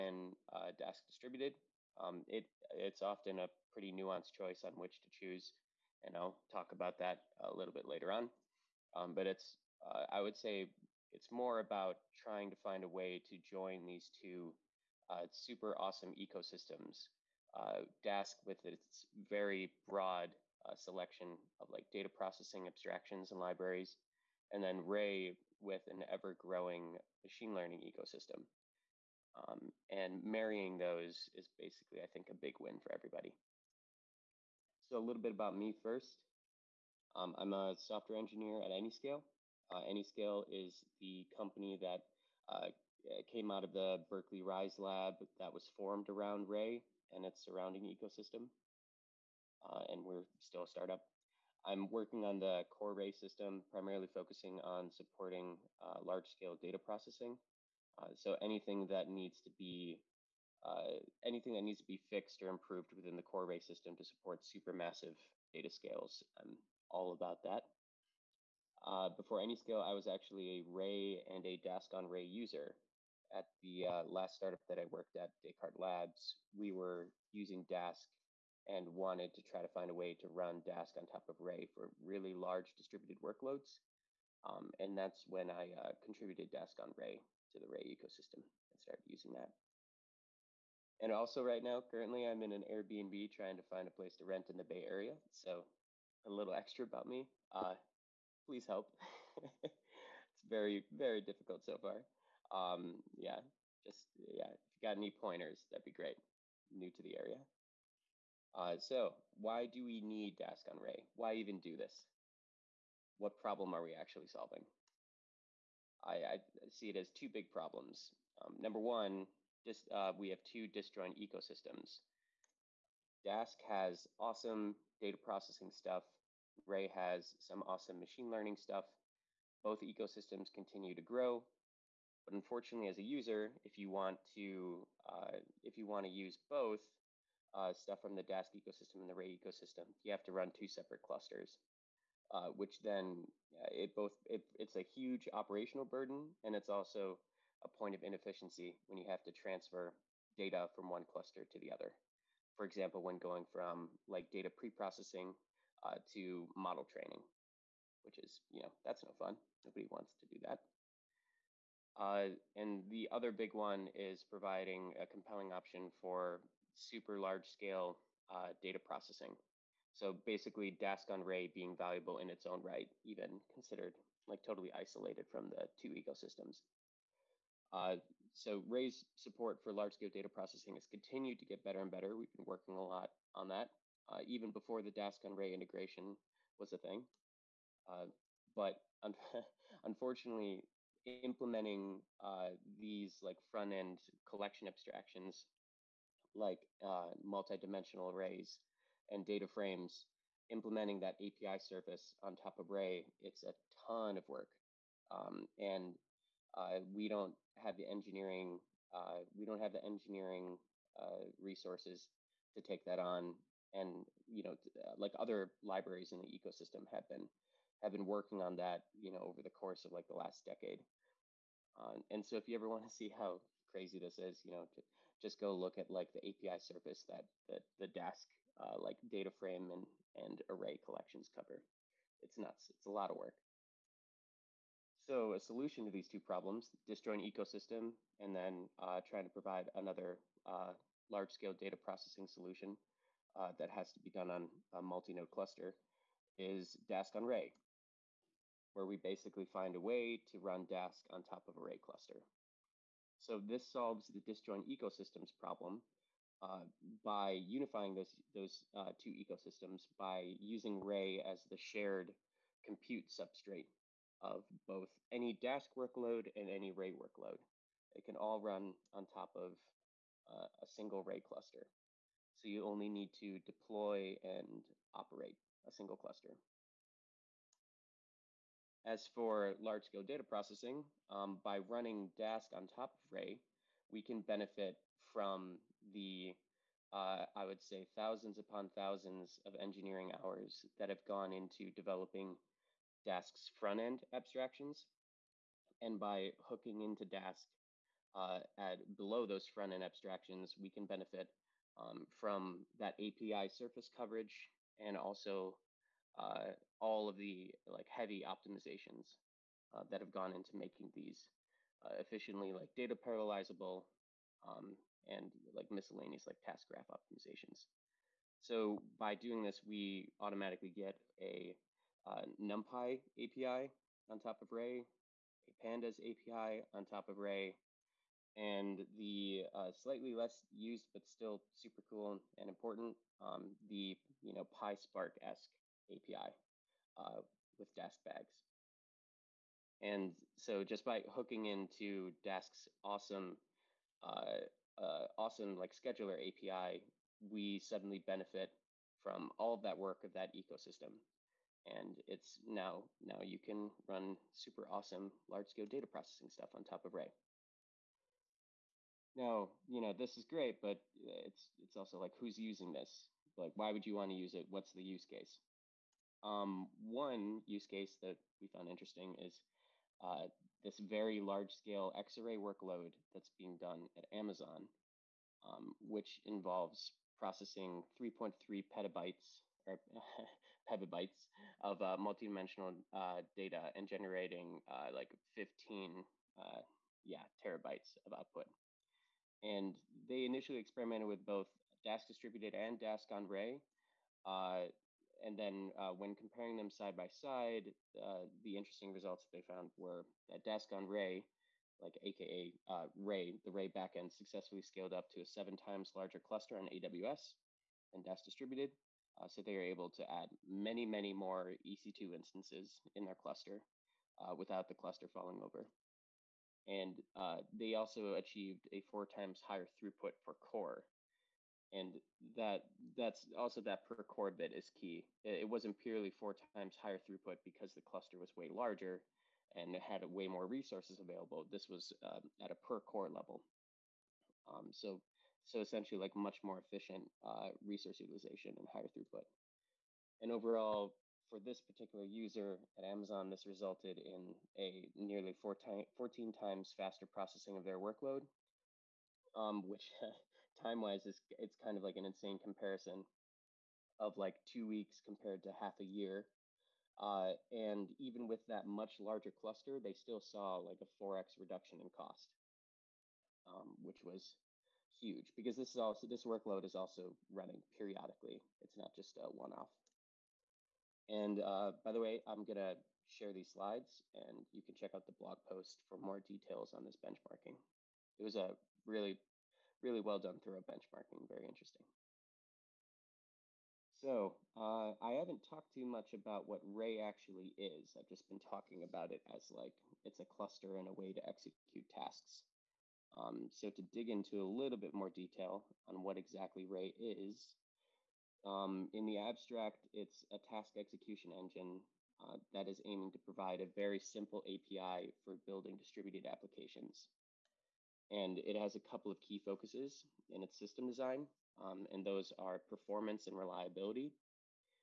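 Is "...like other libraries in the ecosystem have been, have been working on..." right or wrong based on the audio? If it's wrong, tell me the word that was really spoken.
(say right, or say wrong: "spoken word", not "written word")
right.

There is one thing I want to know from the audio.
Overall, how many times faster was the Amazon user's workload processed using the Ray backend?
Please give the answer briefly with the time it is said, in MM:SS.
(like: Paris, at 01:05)
14 times, at 07:25.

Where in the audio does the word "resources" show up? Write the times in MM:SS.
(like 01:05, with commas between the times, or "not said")
03:31, 07:10, 07:17.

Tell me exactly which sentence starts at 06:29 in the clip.
And they initially experimented with both Dask distributed and Dask on Ray.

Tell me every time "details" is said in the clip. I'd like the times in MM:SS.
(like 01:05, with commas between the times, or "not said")
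07:56, 08:15.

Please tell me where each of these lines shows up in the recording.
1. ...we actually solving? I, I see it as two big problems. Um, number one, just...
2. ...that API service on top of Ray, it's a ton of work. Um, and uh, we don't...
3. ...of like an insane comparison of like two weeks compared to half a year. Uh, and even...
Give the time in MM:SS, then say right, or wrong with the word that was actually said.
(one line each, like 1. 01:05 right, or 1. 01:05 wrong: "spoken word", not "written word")
1. 01:53 right
2. 03:21 right
3. 07:31 right.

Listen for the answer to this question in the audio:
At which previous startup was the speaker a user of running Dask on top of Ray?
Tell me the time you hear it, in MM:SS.
01:15.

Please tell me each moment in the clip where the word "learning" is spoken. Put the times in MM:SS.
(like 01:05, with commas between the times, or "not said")
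00:27, 02:08.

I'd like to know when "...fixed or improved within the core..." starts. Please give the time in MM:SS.
01:01.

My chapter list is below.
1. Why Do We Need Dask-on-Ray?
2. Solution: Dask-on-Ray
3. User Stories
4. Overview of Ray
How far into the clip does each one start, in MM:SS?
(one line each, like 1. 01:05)
1. 01:48
2. 03:55
3. 05:58
4. 08:04.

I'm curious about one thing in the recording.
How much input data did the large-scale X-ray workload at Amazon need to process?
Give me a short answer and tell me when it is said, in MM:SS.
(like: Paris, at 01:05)
3.3 petabytes, at 06:17.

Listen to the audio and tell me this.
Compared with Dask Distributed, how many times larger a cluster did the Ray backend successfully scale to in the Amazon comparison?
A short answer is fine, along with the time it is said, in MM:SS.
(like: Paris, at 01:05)
7 times, at 06:45.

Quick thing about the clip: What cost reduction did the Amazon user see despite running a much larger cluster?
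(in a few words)
4x.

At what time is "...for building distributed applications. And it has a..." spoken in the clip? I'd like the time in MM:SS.
08:25.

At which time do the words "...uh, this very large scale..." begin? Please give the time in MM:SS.
06:10.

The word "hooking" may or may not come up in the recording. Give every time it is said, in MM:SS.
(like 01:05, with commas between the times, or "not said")
04:56, 05:41.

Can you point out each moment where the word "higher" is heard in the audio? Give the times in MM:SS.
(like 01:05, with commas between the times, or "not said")
06:59, 07:06, 07:18.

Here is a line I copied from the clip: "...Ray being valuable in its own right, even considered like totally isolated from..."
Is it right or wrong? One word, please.
right.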